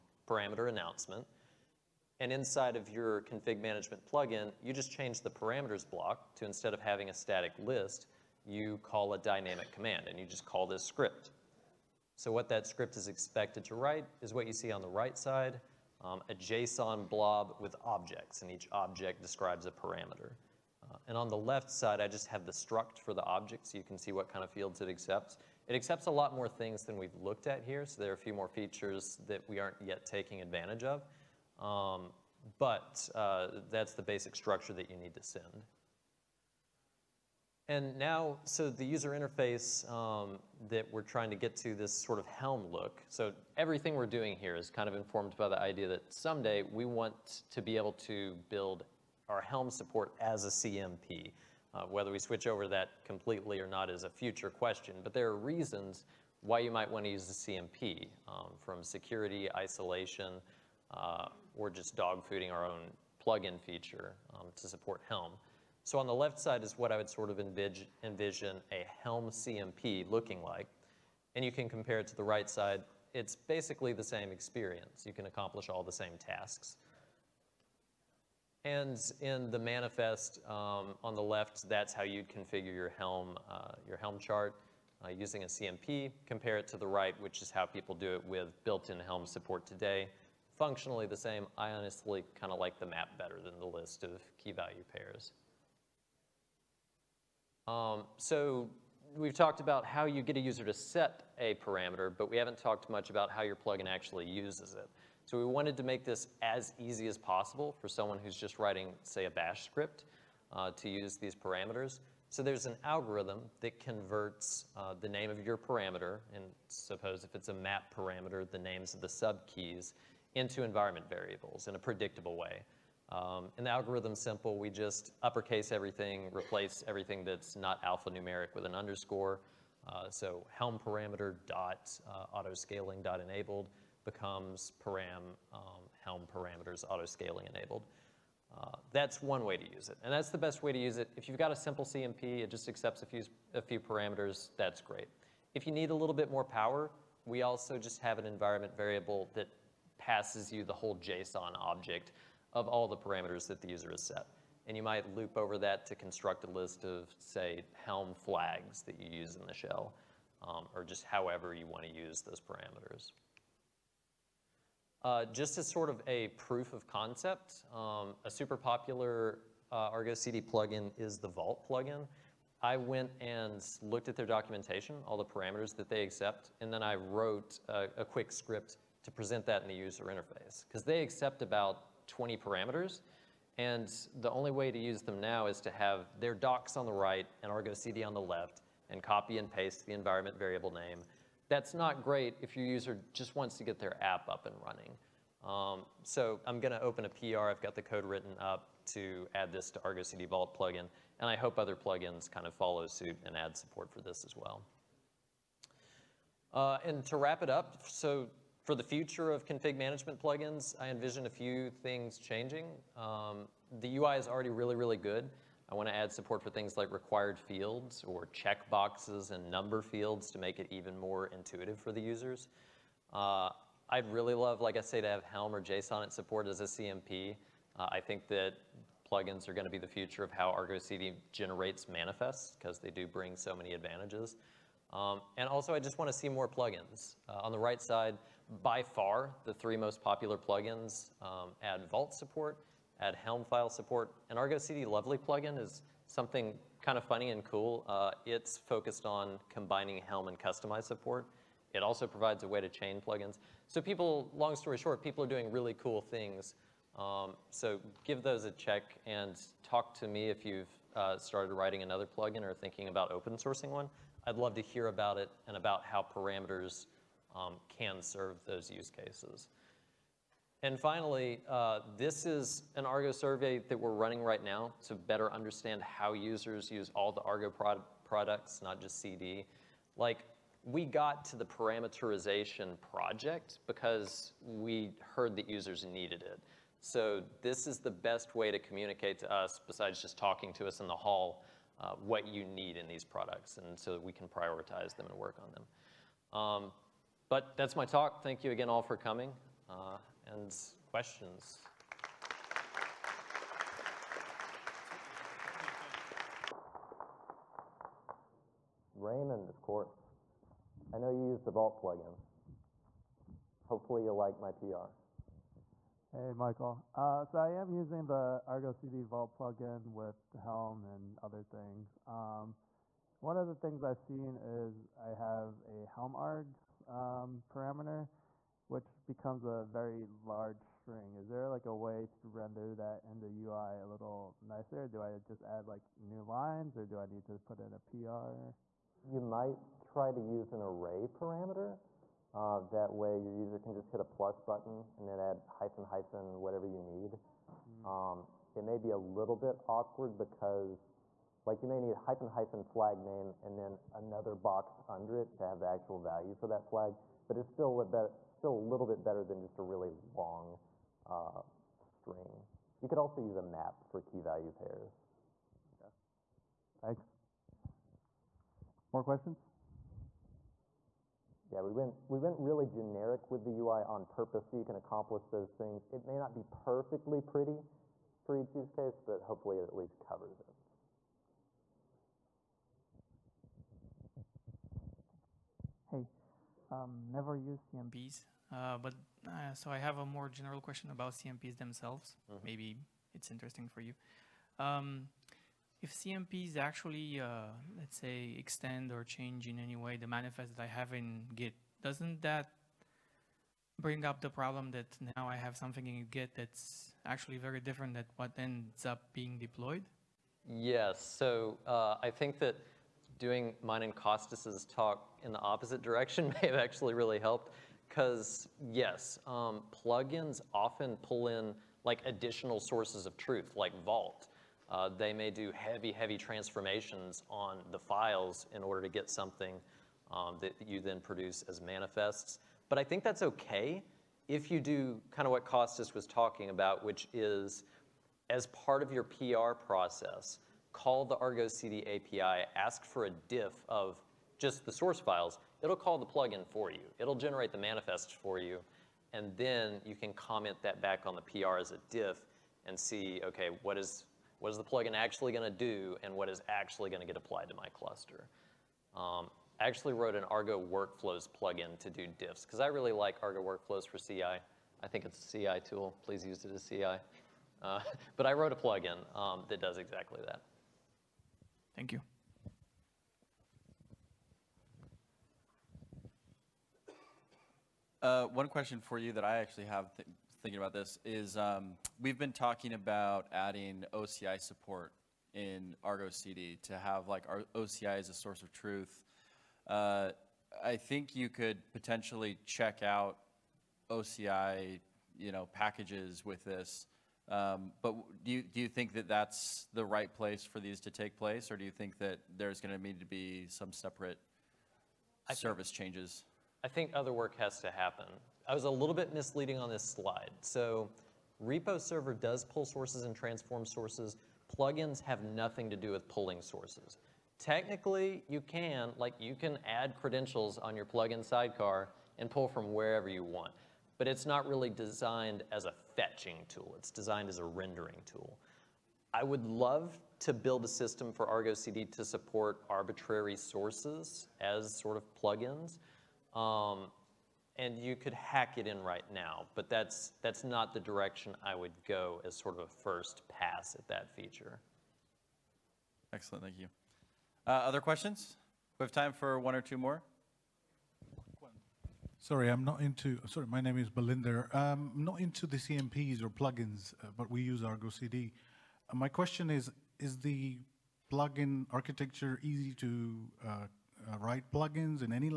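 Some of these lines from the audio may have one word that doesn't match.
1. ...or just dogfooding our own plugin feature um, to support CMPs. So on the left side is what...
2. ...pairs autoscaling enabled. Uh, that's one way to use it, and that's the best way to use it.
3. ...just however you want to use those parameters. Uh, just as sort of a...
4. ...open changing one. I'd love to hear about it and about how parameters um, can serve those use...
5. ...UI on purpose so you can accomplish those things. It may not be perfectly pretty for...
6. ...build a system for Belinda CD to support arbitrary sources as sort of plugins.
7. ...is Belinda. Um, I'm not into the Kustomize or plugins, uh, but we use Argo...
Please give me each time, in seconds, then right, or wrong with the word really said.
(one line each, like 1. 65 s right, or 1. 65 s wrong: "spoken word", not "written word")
1. 61 s wrong: "Helm", not "CMPs"
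2. 136 s wrong: "parameters", not "pairs"
3. 160 s right
4. 263 s wrong: "sourcing", not "changing"
5. 373 s right
6. 530 s wrong: "Argo", not "Belinda"
7. 553 s wrong: "CMPs", not "Kustomize".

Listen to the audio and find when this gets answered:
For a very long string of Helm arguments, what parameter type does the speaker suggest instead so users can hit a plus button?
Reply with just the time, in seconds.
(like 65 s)
340 s.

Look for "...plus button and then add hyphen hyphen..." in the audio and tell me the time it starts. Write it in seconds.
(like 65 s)
344 s.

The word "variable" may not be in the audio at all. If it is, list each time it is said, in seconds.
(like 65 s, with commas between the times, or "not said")
121 s, 148 s, 190 s.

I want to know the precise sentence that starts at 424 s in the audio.
Uh, they may do heavy, heavy transformations on the files in order to get something um, that you then produce as manifests.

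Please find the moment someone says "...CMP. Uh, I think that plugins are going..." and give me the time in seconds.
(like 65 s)
226 s.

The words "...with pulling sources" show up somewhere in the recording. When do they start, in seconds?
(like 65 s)
515 s.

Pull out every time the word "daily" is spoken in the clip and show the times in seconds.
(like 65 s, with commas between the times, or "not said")
not said.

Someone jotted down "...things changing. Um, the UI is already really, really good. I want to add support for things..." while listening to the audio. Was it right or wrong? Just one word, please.
right.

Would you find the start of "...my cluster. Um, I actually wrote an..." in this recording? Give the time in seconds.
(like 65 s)
457 s.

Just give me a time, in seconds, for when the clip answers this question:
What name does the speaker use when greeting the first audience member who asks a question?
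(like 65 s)
308 s.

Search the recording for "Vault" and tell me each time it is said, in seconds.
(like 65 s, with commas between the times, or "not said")
171 s, 200 s, 241 s, 311 s, 319 s, 423 s.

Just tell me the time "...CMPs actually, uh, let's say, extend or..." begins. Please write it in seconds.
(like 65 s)
395 s.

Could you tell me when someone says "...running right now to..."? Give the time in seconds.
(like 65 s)
273 s.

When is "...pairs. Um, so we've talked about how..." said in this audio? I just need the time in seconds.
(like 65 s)
94 s.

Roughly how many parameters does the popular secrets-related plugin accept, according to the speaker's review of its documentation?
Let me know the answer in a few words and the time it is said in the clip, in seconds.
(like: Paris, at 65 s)
20, at 182 s.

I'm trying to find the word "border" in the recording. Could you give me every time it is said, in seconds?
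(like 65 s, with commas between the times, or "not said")
not said.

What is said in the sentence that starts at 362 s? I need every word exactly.
You could also use a map for key value pairs.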